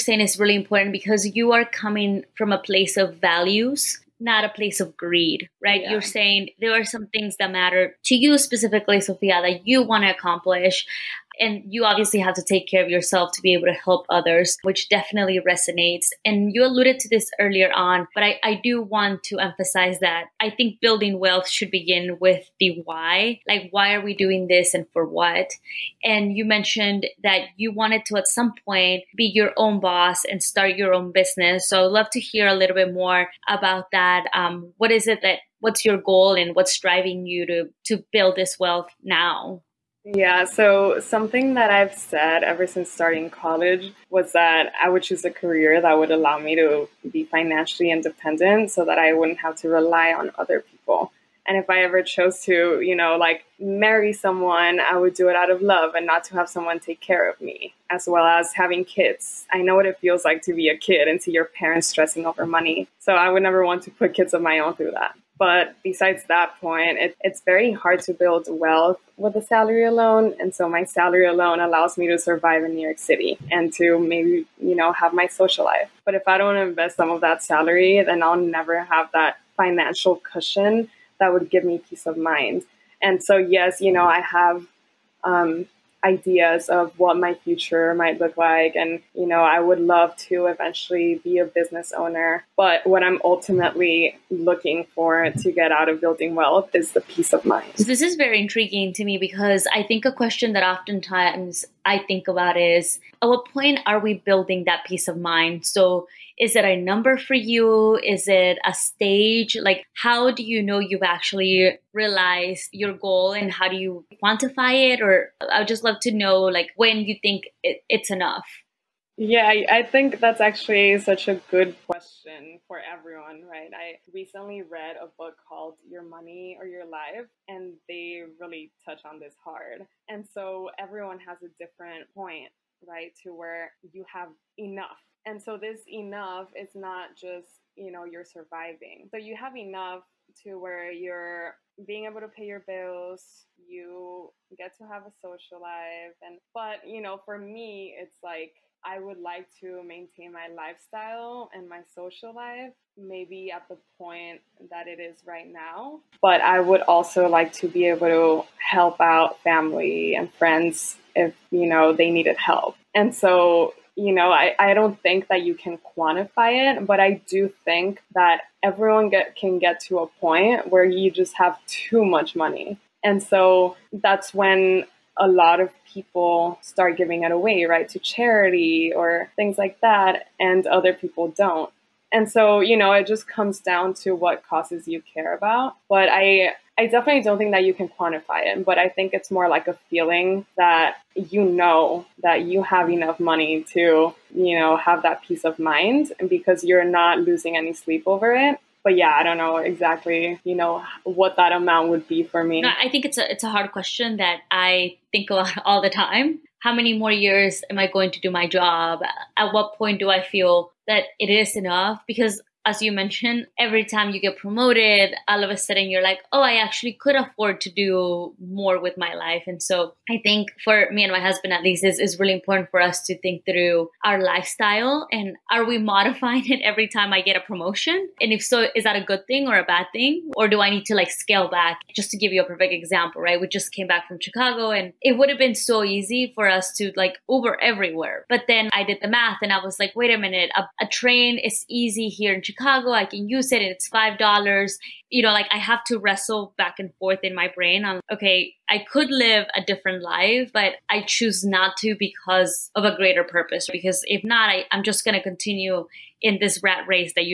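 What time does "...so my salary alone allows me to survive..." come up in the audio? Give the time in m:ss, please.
1:10.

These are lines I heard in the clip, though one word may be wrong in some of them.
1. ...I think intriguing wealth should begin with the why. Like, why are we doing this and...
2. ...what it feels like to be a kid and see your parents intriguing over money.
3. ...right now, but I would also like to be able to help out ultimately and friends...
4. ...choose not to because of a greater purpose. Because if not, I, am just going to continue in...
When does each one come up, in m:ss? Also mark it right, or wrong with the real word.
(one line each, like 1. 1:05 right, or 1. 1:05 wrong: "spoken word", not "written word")
1. 0:20 wrong: "building", not "intriguing"
2. 0:59 wrong: "stressing", not "intriguing"
3. 2:35 wrong: "family", not "ultimately"
4. 4:11 right.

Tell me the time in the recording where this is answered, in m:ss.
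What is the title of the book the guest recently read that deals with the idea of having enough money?
2:05.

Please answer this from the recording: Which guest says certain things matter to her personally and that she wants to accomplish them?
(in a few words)
Sophia.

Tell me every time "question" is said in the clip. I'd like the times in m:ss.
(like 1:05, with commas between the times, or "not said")
1:40, 2:01, 3:23.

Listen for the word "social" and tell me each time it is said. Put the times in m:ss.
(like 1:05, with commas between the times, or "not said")
1:15, 2:25, 2:31.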